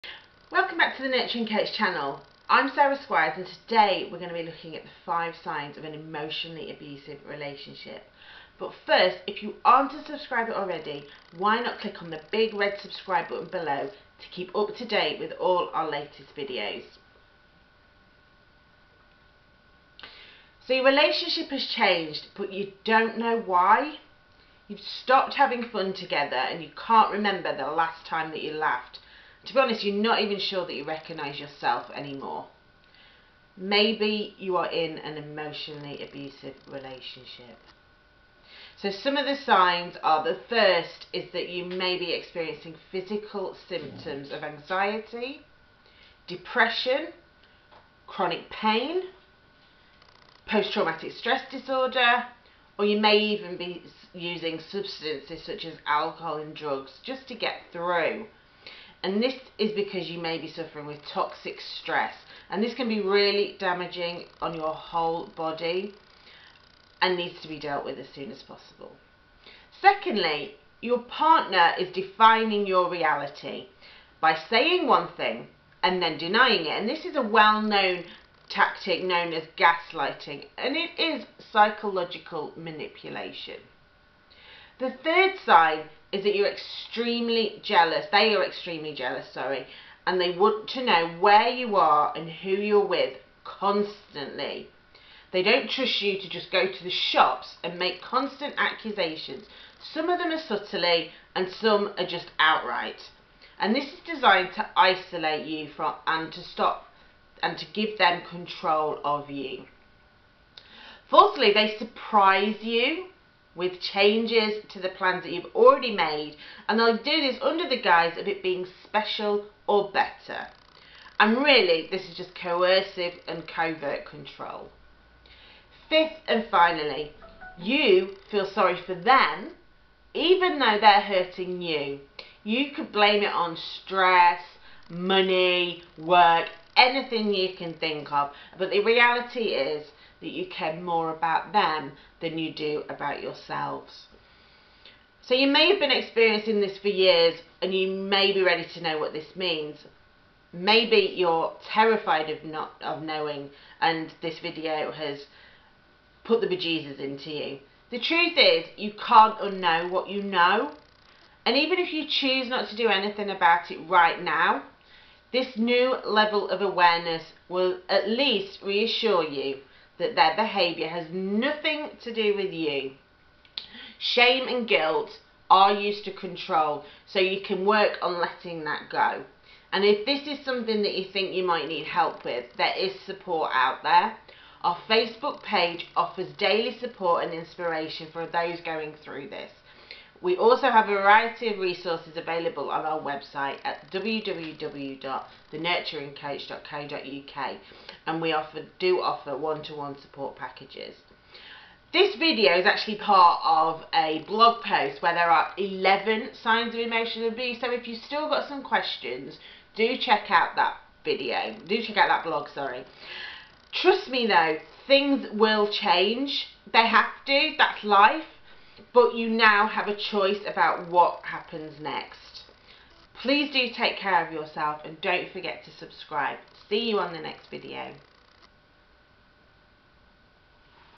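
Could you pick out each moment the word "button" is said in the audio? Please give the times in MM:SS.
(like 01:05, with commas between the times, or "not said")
00:13.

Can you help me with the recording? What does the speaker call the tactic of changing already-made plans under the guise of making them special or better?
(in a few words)
coercive and covert control.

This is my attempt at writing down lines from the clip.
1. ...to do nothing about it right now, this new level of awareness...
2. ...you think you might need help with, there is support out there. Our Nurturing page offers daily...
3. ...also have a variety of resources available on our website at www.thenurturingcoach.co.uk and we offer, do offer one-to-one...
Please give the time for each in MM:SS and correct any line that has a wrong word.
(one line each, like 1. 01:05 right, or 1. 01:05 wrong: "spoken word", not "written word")
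1. 02:42 wrong: "anything", not "nothing"
2. 03:00 wrong: "Facebook", not "Nurturing"
3. 03:10 right.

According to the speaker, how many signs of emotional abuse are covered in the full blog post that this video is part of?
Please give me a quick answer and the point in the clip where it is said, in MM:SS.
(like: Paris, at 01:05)
11, at 03:25.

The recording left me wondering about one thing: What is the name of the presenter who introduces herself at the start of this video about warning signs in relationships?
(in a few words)
Sarah Squires.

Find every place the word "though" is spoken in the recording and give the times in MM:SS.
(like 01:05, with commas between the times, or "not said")
02:10, 03:34.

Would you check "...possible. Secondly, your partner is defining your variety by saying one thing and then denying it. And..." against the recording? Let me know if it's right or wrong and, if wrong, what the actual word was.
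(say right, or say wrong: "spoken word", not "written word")
wrong: "reality", not "variety".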